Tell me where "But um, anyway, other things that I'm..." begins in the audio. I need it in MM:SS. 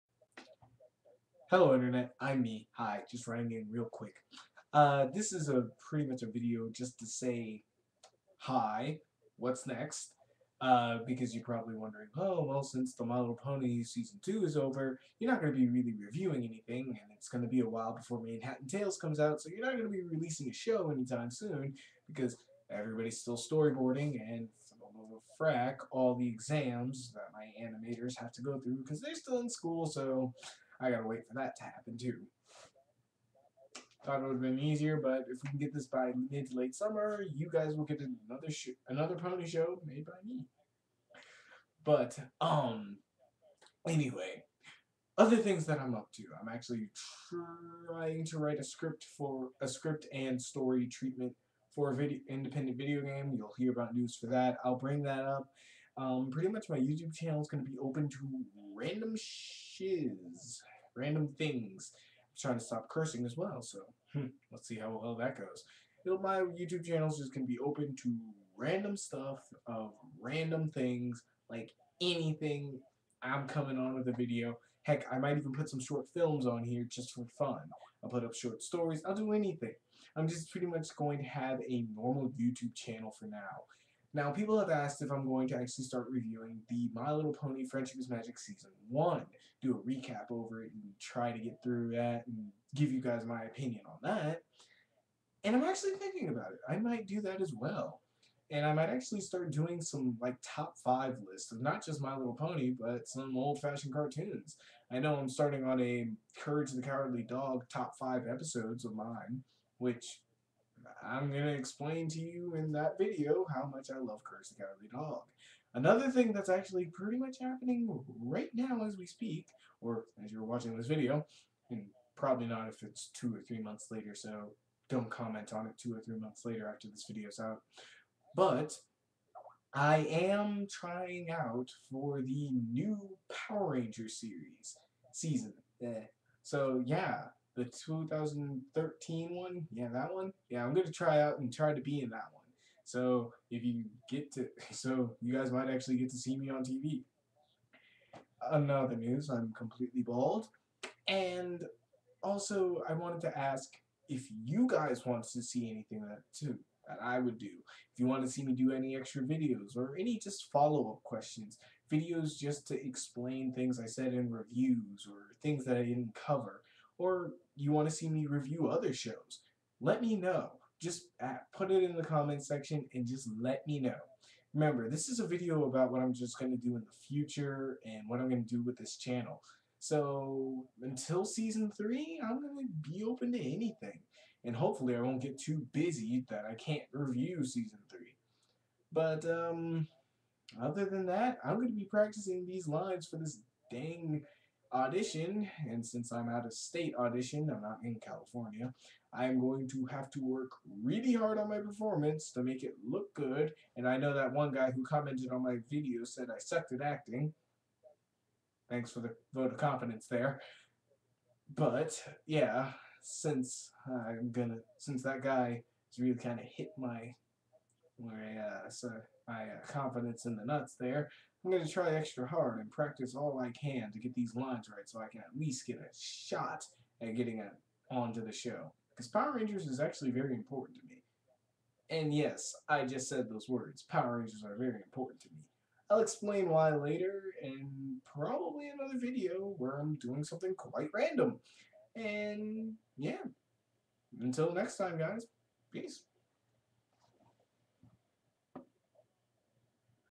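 00:41.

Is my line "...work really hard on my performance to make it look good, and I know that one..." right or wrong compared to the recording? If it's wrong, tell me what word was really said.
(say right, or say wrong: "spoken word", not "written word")
right.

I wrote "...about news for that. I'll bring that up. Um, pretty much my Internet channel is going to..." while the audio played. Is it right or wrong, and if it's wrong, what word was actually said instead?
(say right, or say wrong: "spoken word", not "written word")
wrong: "YouTube", not "Internet".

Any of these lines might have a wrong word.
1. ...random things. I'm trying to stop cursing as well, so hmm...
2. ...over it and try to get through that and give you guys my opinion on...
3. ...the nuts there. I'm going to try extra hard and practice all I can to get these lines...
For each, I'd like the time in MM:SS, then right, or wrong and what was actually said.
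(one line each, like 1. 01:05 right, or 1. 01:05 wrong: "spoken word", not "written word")
1. 01:00 right
2. 01:30 right
3. 03:40 right.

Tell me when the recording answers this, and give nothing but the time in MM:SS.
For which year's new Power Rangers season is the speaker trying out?
02:17.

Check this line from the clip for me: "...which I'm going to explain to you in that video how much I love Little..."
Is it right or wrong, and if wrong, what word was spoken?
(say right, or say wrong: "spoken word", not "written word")
wrong: "Courage", not "Little".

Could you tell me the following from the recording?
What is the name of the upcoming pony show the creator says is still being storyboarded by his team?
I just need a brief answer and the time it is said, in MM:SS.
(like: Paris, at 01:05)
Manhattan Tales, at 00:18.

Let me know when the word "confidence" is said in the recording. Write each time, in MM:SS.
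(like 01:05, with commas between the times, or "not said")
03:29, 03:39.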